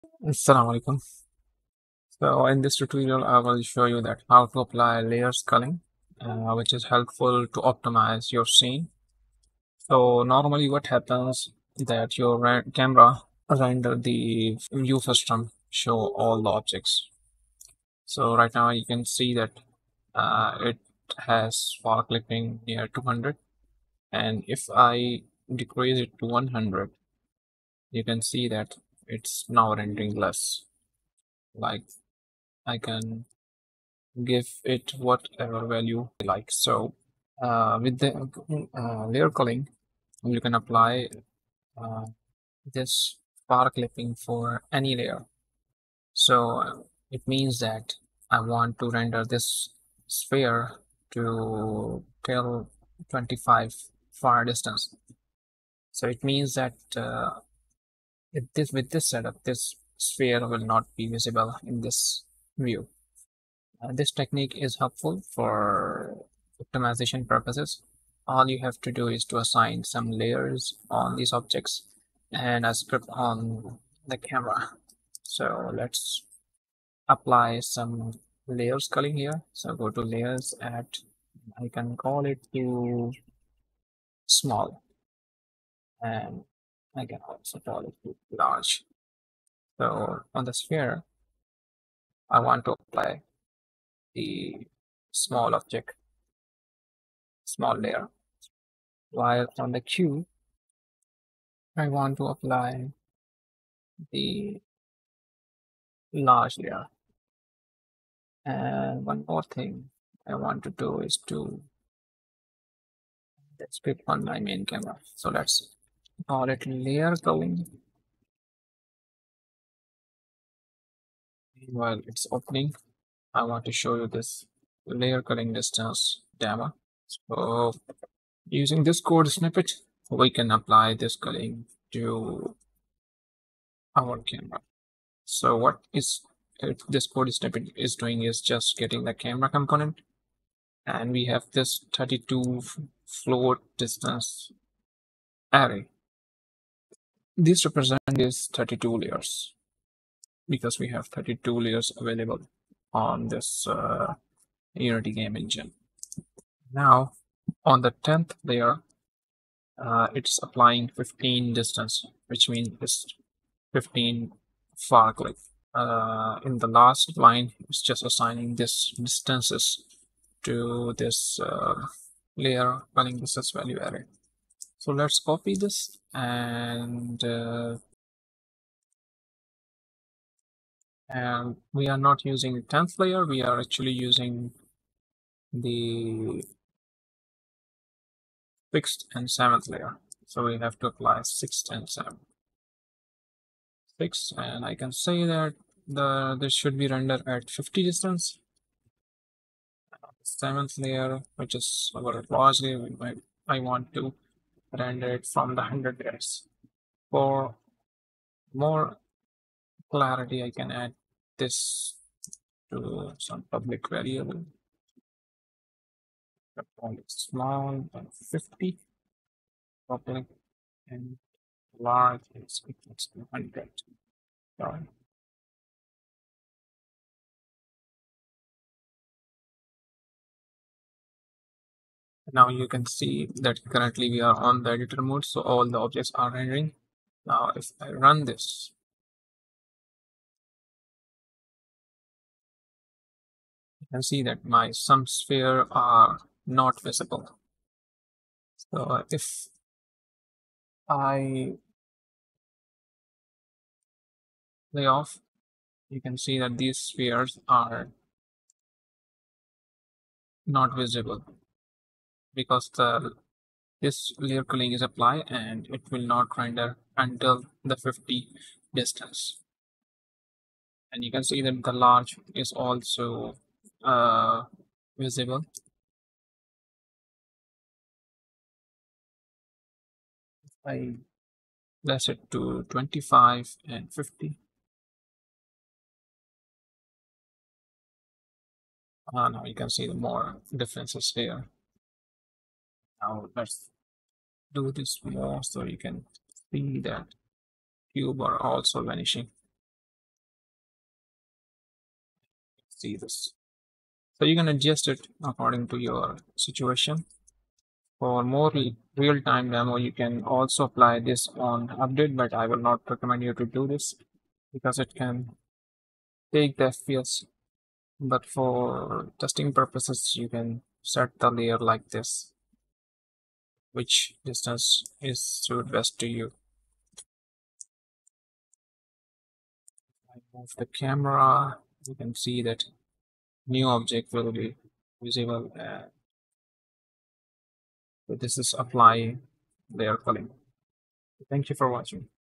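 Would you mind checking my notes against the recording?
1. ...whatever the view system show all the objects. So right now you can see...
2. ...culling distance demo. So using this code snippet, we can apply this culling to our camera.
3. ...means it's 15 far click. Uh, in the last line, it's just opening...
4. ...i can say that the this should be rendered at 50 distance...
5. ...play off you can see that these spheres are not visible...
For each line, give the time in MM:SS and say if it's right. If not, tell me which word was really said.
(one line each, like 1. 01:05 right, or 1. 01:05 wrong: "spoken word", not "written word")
1. 00:13 wrong: "render", not "whatever"
2. 02:05 right
3. 02:42 wrong: "assigning", not "opening"
4. 03:14 right
5. 04:14 right.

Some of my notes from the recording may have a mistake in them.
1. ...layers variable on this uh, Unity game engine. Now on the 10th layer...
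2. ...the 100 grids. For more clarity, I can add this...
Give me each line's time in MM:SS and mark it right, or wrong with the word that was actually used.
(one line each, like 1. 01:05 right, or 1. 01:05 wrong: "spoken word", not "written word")
1. 02:31 wrong: "available", not "variable"
2. 03:25 right.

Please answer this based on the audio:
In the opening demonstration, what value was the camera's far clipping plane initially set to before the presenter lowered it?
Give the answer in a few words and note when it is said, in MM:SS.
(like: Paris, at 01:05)
200, at 00:22.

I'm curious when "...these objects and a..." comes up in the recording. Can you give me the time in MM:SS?
01:11.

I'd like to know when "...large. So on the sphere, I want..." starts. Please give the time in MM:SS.
01:28.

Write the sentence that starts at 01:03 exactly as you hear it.
Uh, this technique is helpful for optimization purposes.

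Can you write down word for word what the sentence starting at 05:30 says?
I move the camera, you can see that new object will be visible.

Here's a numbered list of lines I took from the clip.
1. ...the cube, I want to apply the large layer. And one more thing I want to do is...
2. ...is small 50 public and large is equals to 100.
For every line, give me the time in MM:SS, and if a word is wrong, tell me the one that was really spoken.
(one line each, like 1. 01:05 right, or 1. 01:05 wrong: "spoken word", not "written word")
1. 01:39 right
2. 03:36 right.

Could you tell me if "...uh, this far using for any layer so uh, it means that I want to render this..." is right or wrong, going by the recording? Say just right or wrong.
wrong.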